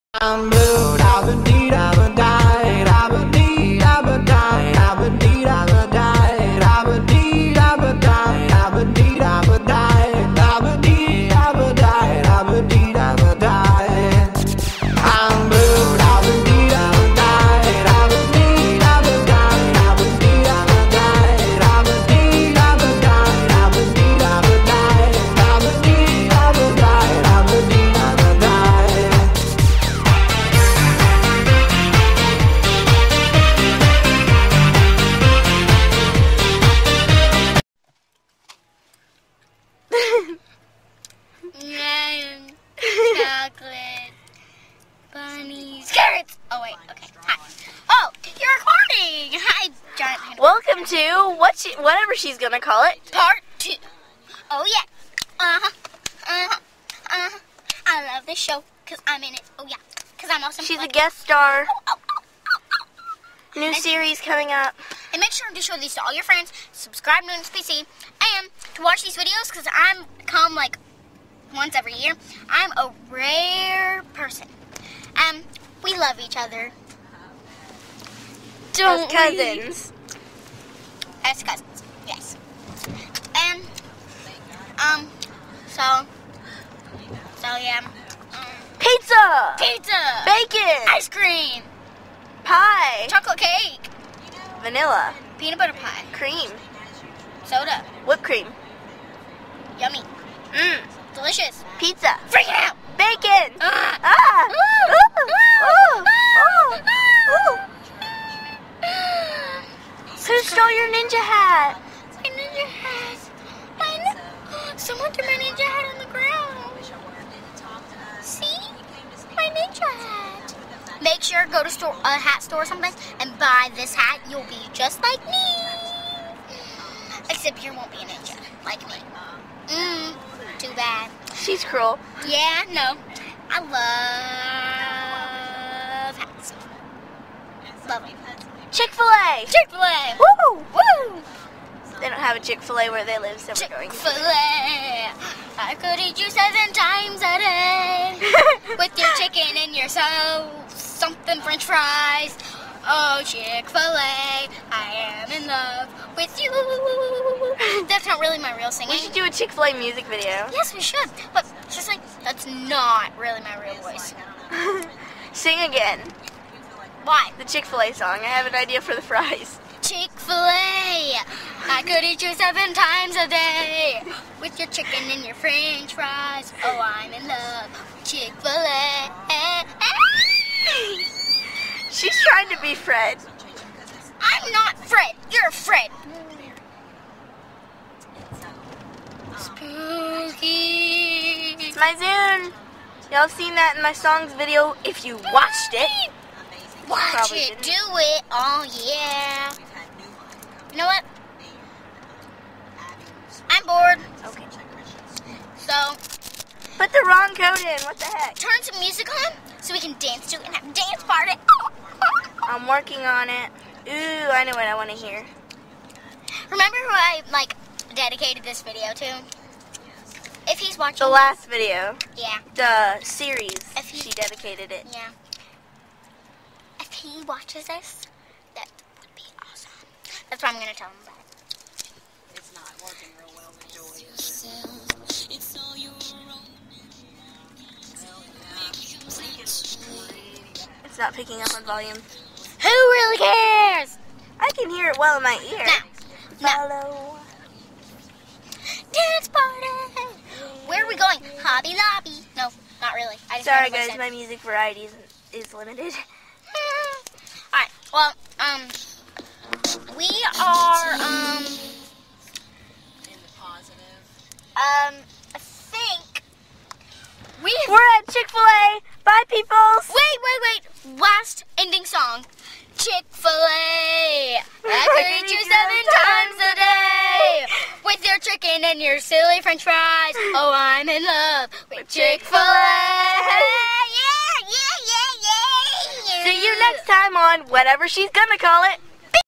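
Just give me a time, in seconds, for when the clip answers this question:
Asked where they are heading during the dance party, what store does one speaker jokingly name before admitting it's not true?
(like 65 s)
251 s.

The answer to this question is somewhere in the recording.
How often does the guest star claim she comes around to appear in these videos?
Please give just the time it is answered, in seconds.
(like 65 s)
71 s.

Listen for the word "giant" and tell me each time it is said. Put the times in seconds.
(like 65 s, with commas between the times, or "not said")
49 s.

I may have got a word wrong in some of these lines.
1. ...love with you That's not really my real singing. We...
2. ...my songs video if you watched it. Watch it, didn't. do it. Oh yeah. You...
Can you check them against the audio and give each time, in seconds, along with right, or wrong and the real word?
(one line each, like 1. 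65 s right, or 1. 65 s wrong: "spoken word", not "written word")
1. 155 s right
2. 193 s right.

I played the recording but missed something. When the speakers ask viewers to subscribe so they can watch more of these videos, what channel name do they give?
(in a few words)
NSPC.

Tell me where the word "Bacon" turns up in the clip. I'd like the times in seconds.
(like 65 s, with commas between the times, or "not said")
90 s, 102 s.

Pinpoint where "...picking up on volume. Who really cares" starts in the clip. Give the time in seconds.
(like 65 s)
241 s.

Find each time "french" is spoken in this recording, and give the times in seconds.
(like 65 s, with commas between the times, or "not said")
151 s, 175 s, 279 s.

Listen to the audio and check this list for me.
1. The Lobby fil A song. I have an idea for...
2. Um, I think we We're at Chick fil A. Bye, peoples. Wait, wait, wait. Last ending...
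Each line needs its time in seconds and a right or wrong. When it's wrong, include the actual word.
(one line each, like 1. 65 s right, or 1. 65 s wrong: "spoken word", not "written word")
1. 167 s wrong: "Chick", not "Lobby"
2. 264 s right.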